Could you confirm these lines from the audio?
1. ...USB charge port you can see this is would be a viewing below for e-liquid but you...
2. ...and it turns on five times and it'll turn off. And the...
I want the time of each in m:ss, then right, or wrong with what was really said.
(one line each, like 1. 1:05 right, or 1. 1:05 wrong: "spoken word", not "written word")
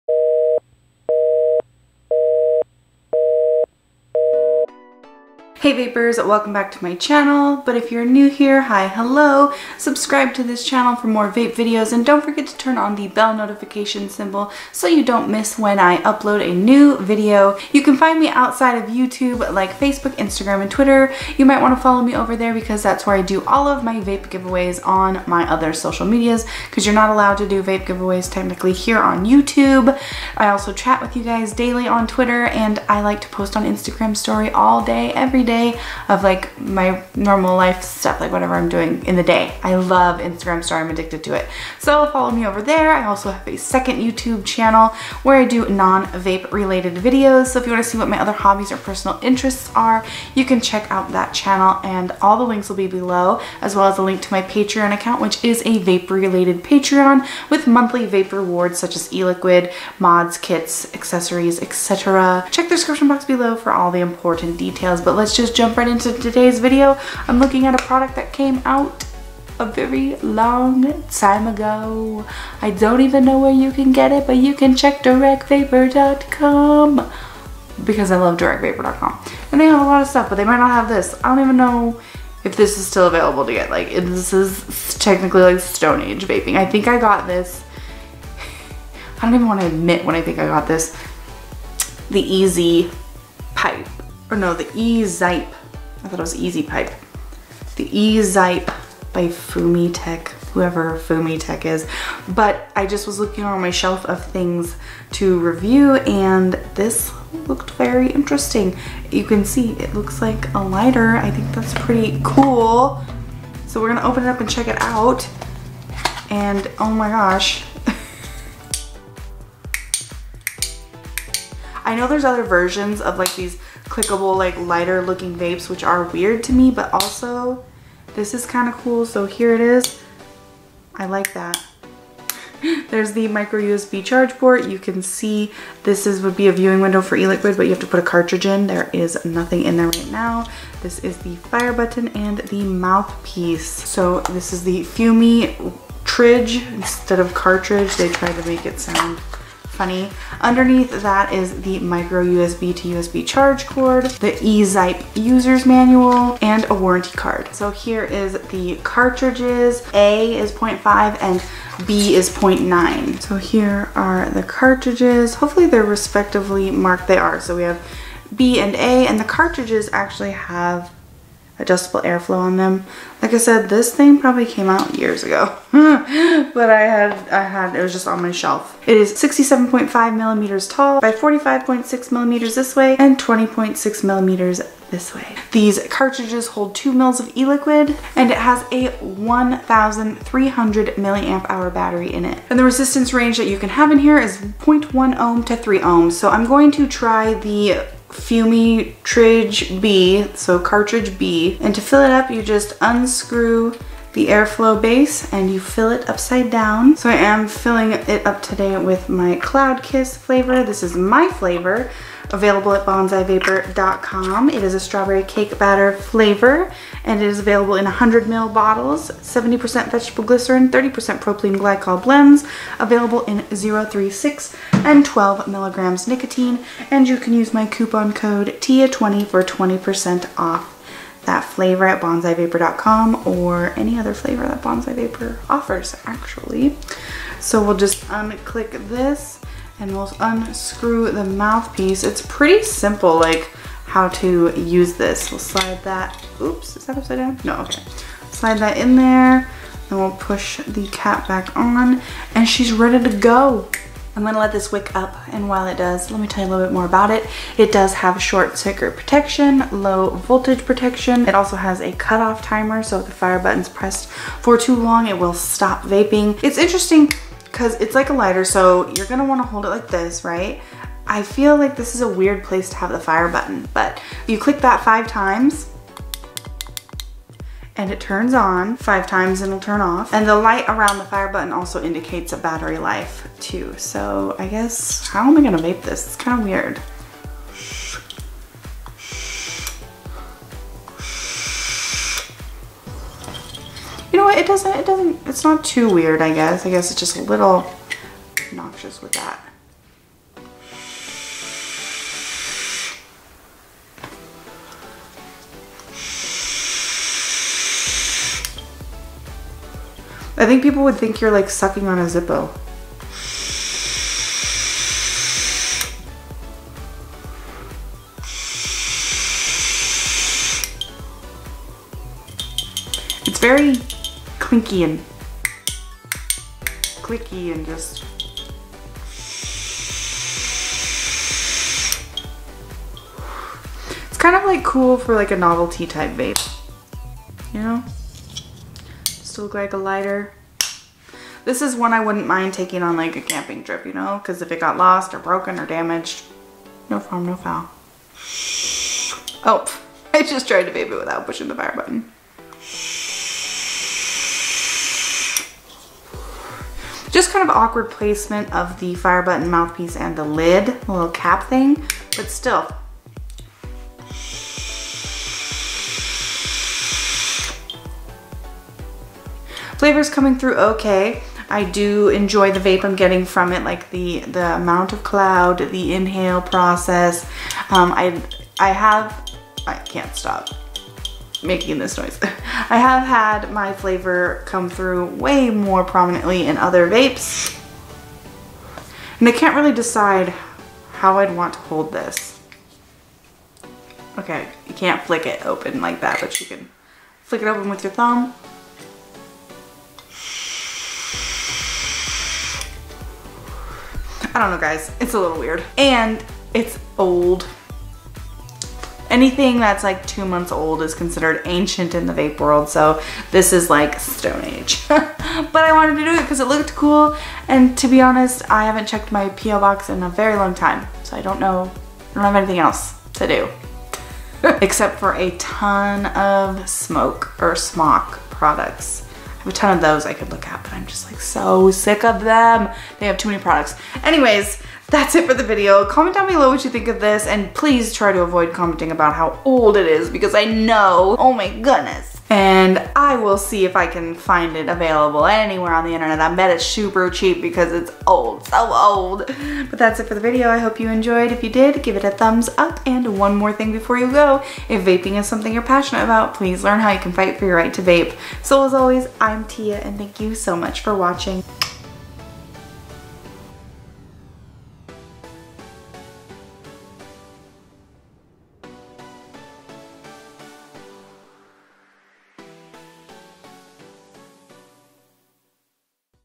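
1. 2:13 wrong: "window", not "below"
2. 4:37 right.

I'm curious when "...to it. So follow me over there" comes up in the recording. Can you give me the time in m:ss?
0:41.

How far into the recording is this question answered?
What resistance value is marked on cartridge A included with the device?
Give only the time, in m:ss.
2:40.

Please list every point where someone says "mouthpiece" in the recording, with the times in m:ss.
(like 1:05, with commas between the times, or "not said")
2:22, 4:01, 5:59.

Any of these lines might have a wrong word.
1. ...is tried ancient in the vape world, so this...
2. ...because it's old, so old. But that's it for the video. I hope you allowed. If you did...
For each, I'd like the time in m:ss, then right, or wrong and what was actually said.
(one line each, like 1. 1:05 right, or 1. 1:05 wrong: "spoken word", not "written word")
1. 6:50 wrong: "considered", not "tried"
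2. 7:27 wrong: "enjoyed", not "allowed".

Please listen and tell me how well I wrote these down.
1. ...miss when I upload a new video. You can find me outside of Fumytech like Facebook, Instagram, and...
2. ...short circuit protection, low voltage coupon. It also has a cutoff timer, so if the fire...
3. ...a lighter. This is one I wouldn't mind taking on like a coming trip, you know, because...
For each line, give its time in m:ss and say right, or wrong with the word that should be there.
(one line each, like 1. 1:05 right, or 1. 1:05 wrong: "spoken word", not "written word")
1. 0:15 wrong: "YouTube", not "Fumytech"
2. 4:18 wrong: "protection", not "coupon"
3. 5:39 wrong: "camping", not "coming".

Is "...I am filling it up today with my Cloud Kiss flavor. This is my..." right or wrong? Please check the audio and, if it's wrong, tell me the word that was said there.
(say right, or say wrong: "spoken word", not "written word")
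right.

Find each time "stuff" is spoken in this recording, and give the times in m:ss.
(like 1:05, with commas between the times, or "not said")
0:37, 1:20.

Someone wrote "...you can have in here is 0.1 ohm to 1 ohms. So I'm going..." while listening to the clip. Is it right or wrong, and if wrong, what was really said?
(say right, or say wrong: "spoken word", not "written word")
wrong: "3", not "1".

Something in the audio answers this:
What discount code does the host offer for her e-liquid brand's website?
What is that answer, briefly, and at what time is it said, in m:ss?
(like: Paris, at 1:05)
TIA20, at 3:48.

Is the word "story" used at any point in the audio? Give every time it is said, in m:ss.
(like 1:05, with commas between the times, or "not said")
0:34, 0:40.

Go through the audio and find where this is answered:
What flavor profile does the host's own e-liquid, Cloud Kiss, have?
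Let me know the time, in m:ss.
3:34.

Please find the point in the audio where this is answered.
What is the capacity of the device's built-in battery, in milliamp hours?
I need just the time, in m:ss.
3:09.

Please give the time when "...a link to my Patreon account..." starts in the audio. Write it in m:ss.
0:53.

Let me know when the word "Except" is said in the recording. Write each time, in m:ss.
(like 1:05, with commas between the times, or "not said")
7:04.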